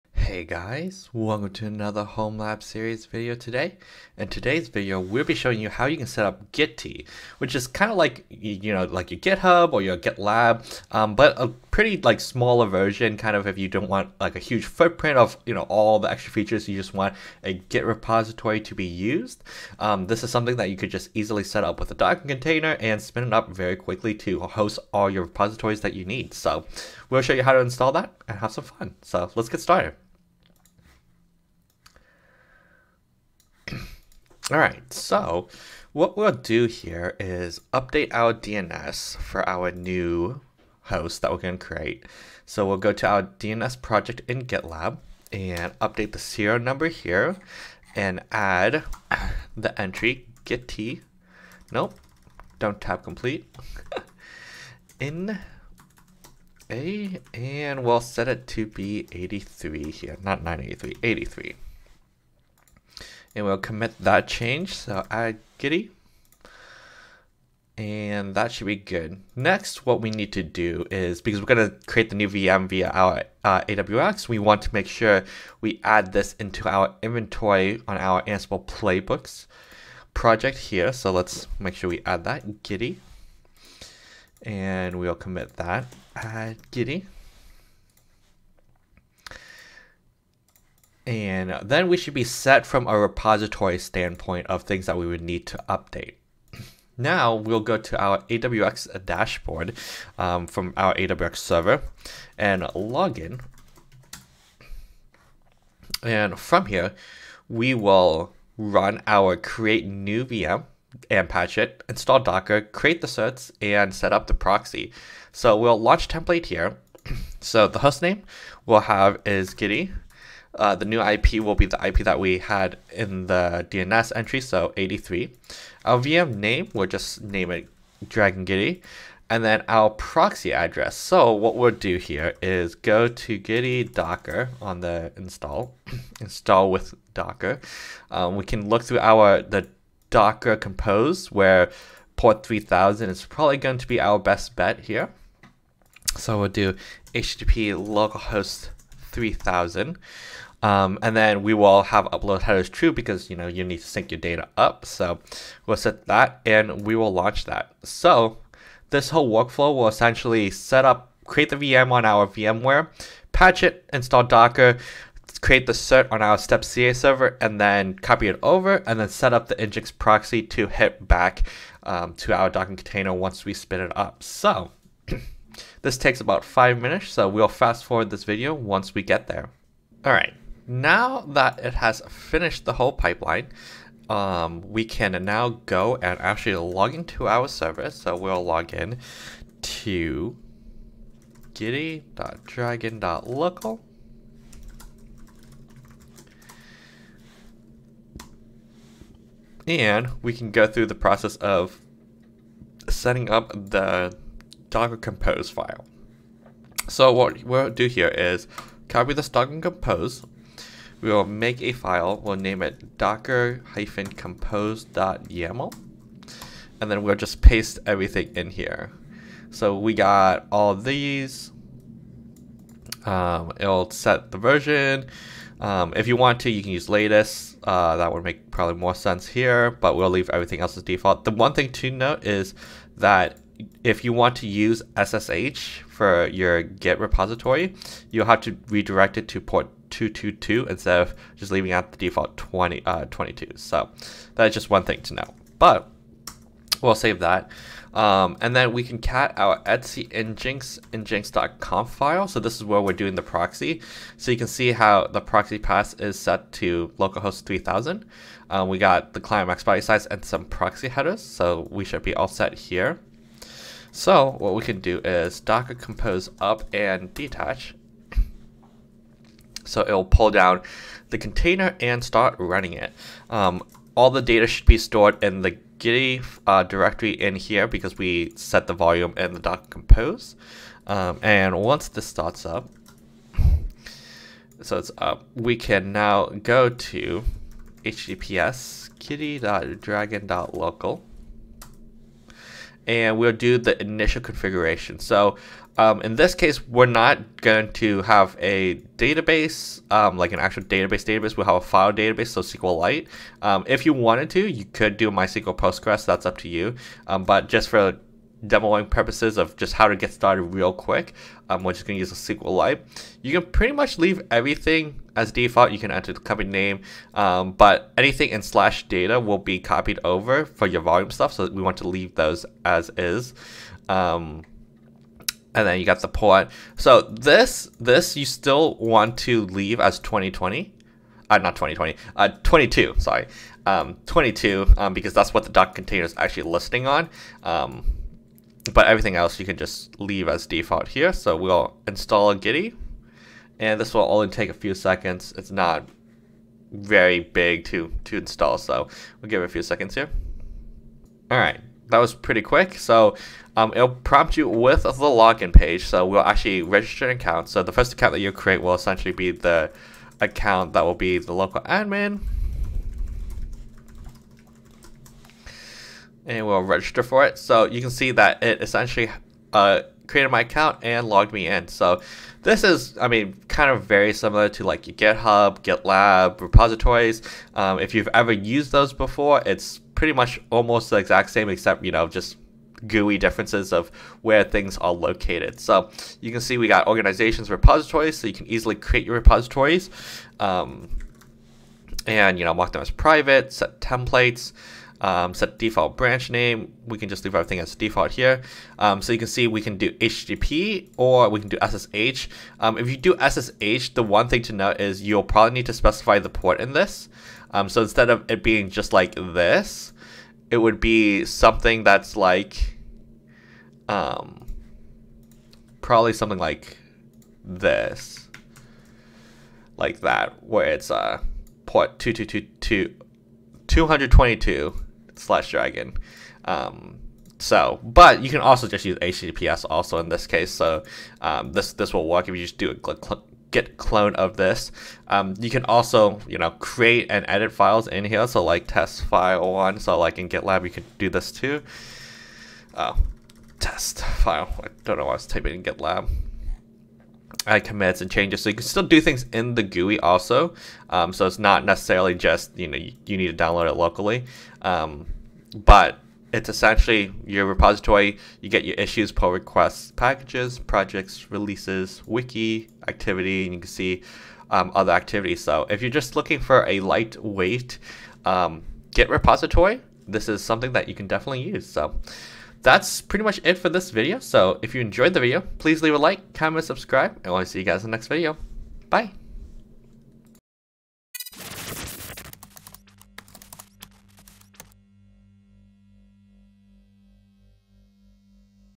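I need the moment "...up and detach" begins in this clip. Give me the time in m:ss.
4:26.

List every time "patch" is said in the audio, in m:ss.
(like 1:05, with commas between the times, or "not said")
1:51, 2:43.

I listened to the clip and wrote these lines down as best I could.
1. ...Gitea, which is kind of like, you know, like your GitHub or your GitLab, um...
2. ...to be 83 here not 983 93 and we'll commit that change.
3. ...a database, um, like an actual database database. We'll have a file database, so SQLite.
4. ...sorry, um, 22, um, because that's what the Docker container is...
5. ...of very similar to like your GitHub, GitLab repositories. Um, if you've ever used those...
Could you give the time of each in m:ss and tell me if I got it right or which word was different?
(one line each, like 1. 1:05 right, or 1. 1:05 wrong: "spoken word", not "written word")
1. 0:06 right
2. 0:58 wrong: "83", not "93"
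3. 4:58 right
4. 5:32 right
5. 6:13 right.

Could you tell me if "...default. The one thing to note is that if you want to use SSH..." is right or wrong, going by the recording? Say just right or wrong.
right.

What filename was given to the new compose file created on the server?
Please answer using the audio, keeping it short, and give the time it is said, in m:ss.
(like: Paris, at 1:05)
docker-compose.yaml, at 3:32.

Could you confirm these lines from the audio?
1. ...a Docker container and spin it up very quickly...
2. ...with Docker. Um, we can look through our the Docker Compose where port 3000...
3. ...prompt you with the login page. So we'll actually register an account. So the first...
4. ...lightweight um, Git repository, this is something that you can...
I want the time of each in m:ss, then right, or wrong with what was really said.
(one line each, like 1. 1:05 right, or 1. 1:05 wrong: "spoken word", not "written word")
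1. 0:21 right
2. 2:16 right
3. 5:53 right
4. 7:46 right.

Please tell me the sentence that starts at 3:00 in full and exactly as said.
Alright, now that it has finished the whole pipeline, um, we can now go and actually log into our server.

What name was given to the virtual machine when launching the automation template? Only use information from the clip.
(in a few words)
Dragon Giddy.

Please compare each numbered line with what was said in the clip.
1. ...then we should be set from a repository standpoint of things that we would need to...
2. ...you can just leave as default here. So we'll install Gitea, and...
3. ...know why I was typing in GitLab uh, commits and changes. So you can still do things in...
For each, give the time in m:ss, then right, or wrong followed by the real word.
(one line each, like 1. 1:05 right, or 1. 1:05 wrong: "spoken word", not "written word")
1. 1:31 right
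2. 5:39 right
3. 7:24 right.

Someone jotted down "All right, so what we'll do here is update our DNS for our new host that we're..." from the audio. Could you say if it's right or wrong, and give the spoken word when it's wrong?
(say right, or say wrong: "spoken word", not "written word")
right.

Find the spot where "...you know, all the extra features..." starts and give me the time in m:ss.
0:15.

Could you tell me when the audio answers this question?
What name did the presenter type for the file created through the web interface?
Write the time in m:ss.
7:18.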